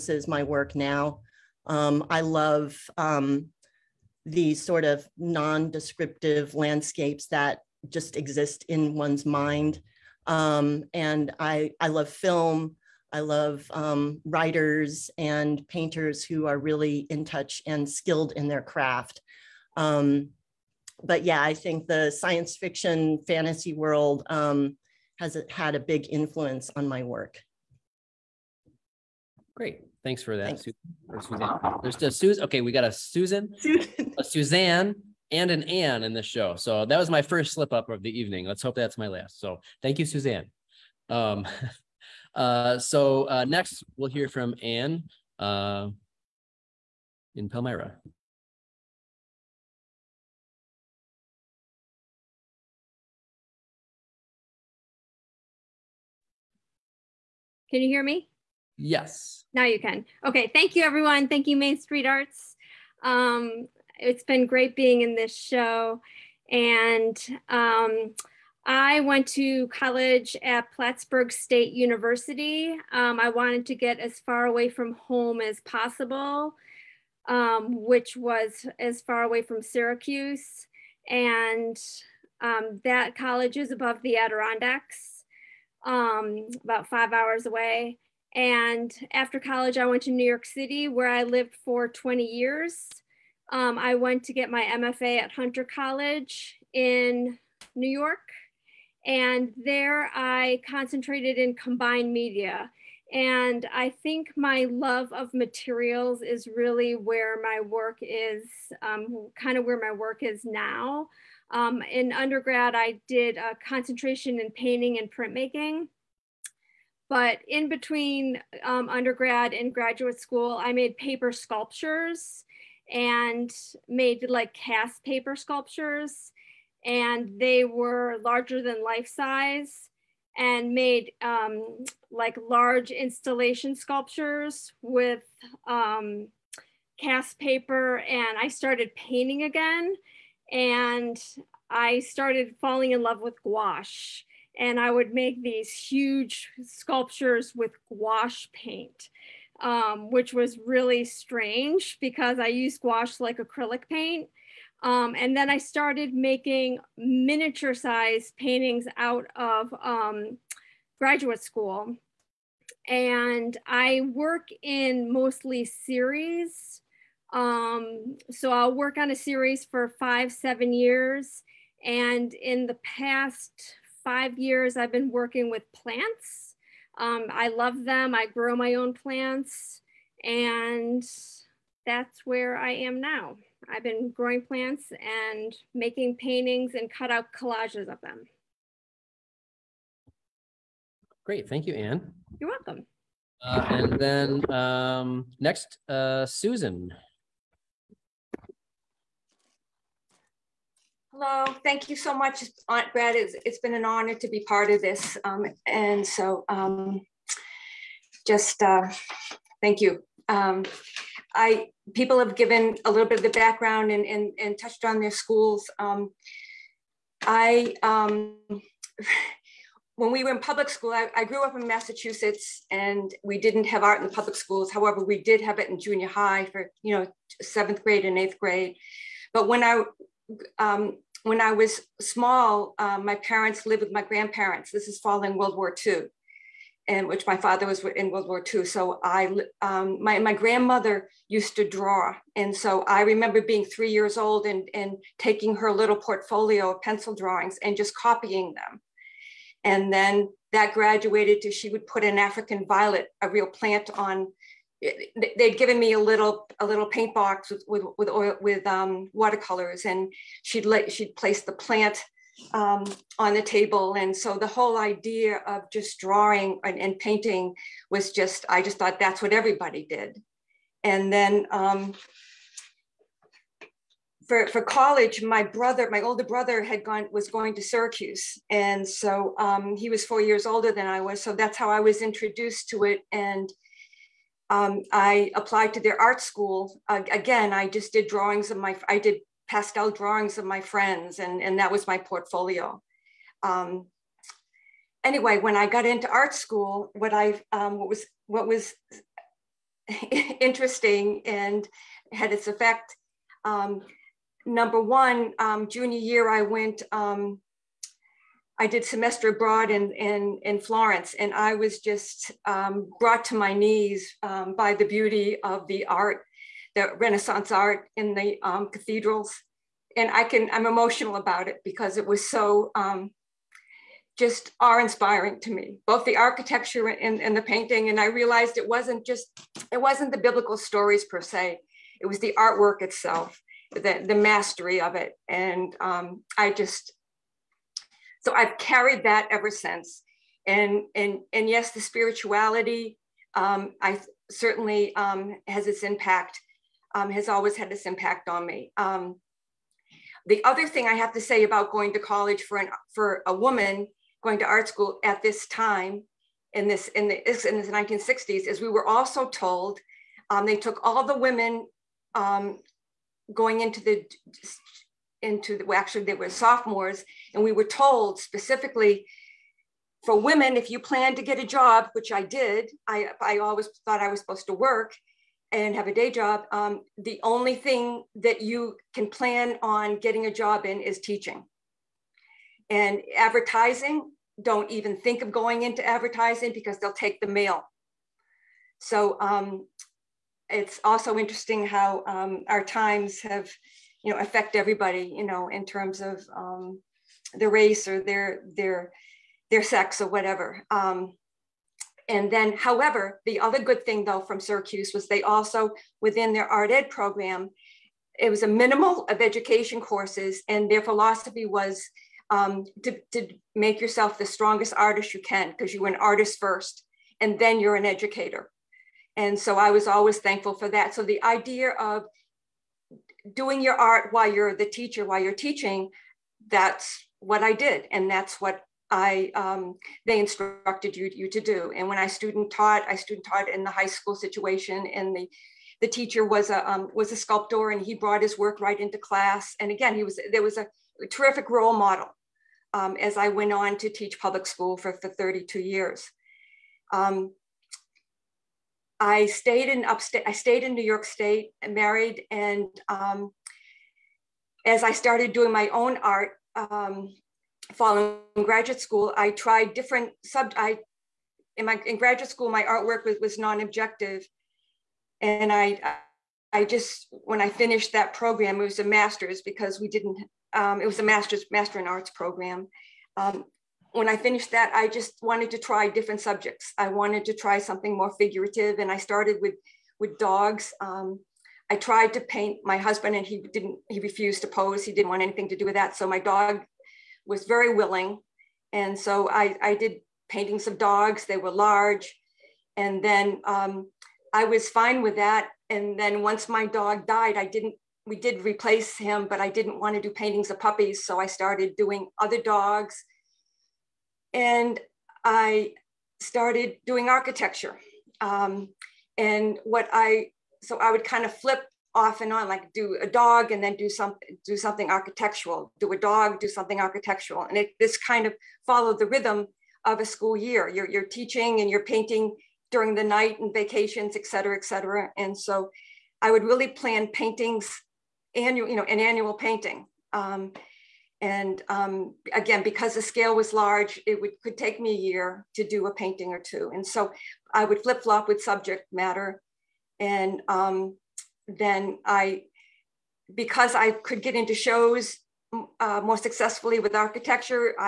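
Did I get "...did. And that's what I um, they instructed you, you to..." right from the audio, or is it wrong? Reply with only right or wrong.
right.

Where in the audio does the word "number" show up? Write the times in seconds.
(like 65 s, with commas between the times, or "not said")
304 s.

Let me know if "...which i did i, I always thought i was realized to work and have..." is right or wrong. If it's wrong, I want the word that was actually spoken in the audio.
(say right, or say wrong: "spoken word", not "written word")
wrong: "supposed", not "realized".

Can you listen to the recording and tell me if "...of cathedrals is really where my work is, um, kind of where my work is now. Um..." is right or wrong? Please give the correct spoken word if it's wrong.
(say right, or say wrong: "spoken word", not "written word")
wrong: "materials", not "cathedrals".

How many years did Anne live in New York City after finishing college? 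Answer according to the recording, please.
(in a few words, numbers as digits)
20.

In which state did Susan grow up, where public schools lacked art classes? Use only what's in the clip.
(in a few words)
Massachusetts.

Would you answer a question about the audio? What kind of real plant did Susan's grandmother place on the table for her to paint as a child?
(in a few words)
African violet.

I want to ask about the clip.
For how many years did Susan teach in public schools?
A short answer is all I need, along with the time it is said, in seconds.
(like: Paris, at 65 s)
32, at 445 s.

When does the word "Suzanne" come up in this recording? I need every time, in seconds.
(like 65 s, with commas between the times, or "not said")
34 s, 40 s.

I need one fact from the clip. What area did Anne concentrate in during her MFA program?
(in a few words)
combined media.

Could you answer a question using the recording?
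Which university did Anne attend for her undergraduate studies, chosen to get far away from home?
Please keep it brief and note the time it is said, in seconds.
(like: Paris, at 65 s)
Plattsburgh State University, at 70 s.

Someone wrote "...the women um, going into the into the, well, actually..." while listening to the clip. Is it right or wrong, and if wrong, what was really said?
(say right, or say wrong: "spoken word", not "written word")
right.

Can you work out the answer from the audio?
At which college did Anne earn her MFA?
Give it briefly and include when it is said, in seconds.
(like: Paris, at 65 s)
Hunter College, at 95 s.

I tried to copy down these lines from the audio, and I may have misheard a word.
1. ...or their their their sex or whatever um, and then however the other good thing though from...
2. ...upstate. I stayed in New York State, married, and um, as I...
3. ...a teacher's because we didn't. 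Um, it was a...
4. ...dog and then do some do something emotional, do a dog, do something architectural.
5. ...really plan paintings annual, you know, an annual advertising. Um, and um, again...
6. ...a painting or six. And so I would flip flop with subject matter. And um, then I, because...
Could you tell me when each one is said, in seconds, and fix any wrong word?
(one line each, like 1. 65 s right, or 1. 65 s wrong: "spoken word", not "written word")
1. 397 s right
2. 449 s right
3. 468 s wrong: "master", not "teacher"
4. 513 s wrong: "architectural", not "emotional"
5. 526 s wrong: "painting", not "advertising"
6. 535 s wrong: "two", not "six".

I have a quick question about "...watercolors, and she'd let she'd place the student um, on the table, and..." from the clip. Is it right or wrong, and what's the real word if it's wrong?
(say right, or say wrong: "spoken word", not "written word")
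wrong: "plant", not "student".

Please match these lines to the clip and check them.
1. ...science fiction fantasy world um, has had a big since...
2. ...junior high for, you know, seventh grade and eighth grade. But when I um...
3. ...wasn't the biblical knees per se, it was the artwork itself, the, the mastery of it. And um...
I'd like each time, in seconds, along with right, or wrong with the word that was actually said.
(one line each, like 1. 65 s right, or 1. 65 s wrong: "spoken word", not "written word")
1. 22 s wrong: "influence", not "since"
2. 225 s right
3. 329 s wrong: "stories", not "knees".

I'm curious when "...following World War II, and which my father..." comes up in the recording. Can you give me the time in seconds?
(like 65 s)
234 s.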